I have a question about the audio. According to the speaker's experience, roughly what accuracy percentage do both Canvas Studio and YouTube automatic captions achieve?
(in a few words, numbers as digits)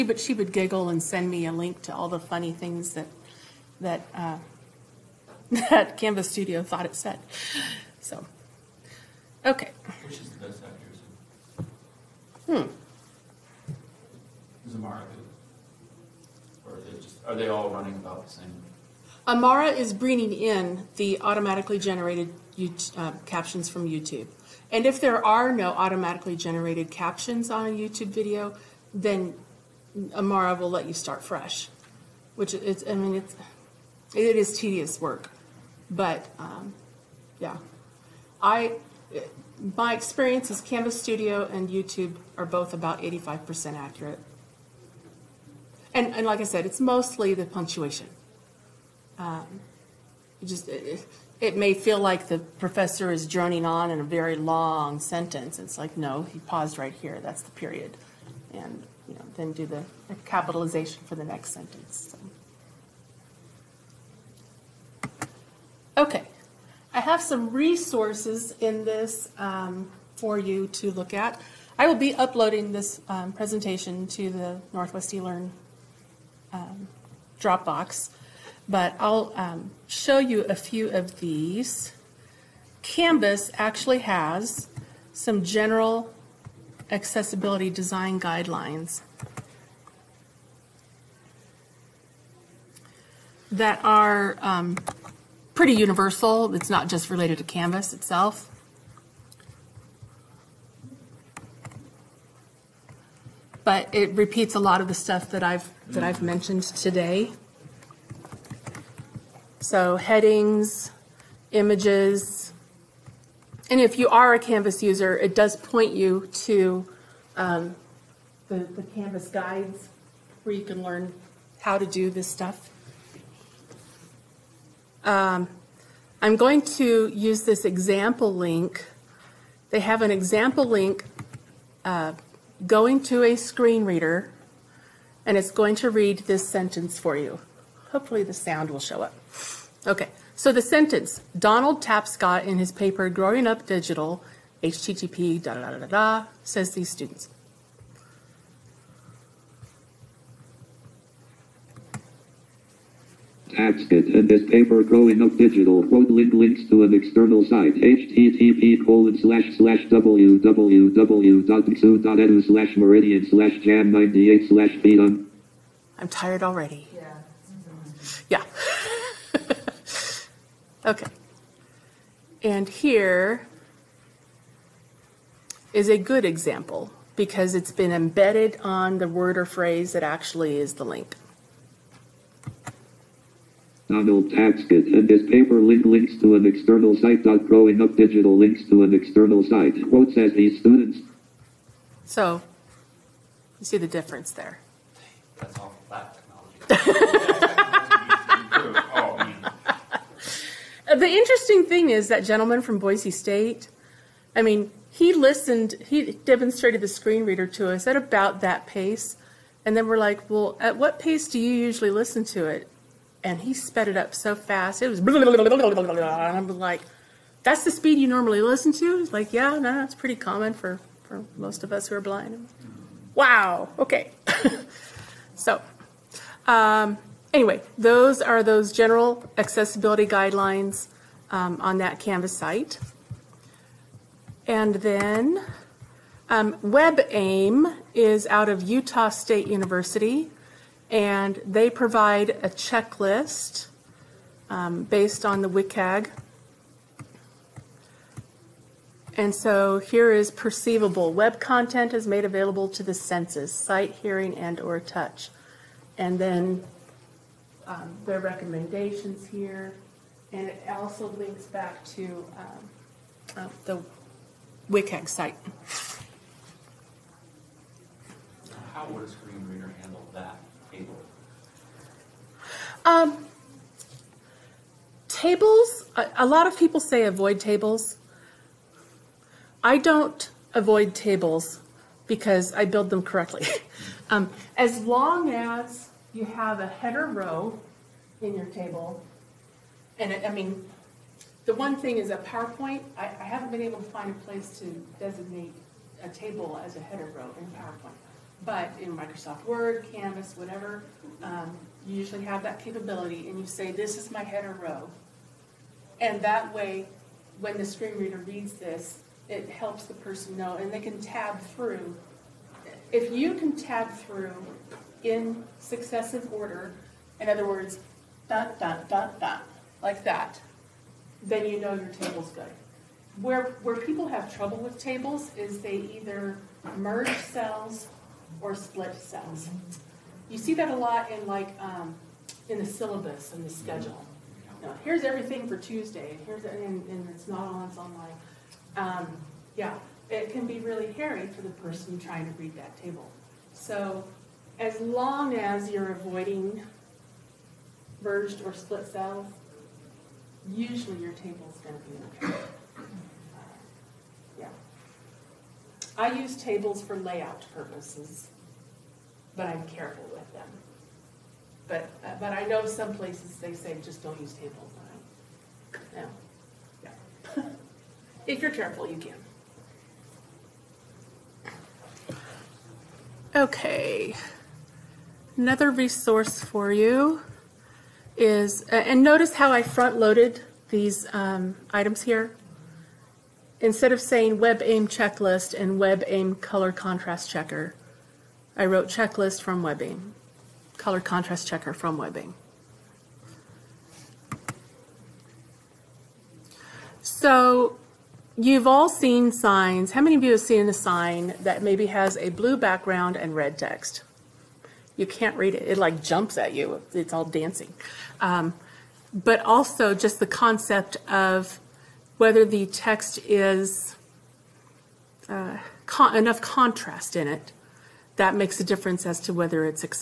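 85%.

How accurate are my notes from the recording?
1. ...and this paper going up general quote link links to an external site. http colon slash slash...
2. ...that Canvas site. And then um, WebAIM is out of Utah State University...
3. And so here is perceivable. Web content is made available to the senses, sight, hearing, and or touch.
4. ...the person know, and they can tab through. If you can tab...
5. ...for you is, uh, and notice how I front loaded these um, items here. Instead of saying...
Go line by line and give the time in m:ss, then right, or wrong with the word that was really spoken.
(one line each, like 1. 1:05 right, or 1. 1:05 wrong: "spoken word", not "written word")
1. 2:33 wrong: "digital", not "general"
2. 3:51 right
3. 4:09 right
4. 5:09 right
5. 6:16 right.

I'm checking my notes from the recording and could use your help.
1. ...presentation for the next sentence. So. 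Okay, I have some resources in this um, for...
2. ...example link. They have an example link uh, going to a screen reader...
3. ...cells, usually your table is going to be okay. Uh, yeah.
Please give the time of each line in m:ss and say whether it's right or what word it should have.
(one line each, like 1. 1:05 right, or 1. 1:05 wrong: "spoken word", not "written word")
1. 1:00 wrong: "capitalization", not "presentation"
2. 2:07 right
3. 5:48 right.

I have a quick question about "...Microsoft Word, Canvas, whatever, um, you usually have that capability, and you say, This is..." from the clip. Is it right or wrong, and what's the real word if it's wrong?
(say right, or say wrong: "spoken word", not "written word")
right.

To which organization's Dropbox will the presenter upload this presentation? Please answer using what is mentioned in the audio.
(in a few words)
Northwest eLearn.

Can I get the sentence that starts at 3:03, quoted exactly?
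Donald Tapscott and his paper link links to an external site.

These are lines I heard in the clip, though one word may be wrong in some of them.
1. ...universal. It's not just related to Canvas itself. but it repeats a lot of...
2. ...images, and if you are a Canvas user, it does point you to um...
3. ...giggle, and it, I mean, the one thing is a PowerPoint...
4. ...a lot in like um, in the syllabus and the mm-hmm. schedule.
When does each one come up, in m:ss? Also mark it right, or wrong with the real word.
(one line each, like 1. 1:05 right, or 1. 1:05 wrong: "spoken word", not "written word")
1. 1:35 right
2. 1:51 right
3. 4:48 wrong: "table", not "giggle"
4. 5:30 right.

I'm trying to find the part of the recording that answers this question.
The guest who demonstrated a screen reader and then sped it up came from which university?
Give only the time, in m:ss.
3:22.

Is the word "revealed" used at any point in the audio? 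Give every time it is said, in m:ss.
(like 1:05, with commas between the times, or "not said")
not said.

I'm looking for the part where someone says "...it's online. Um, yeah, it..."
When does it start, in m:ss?
5:37.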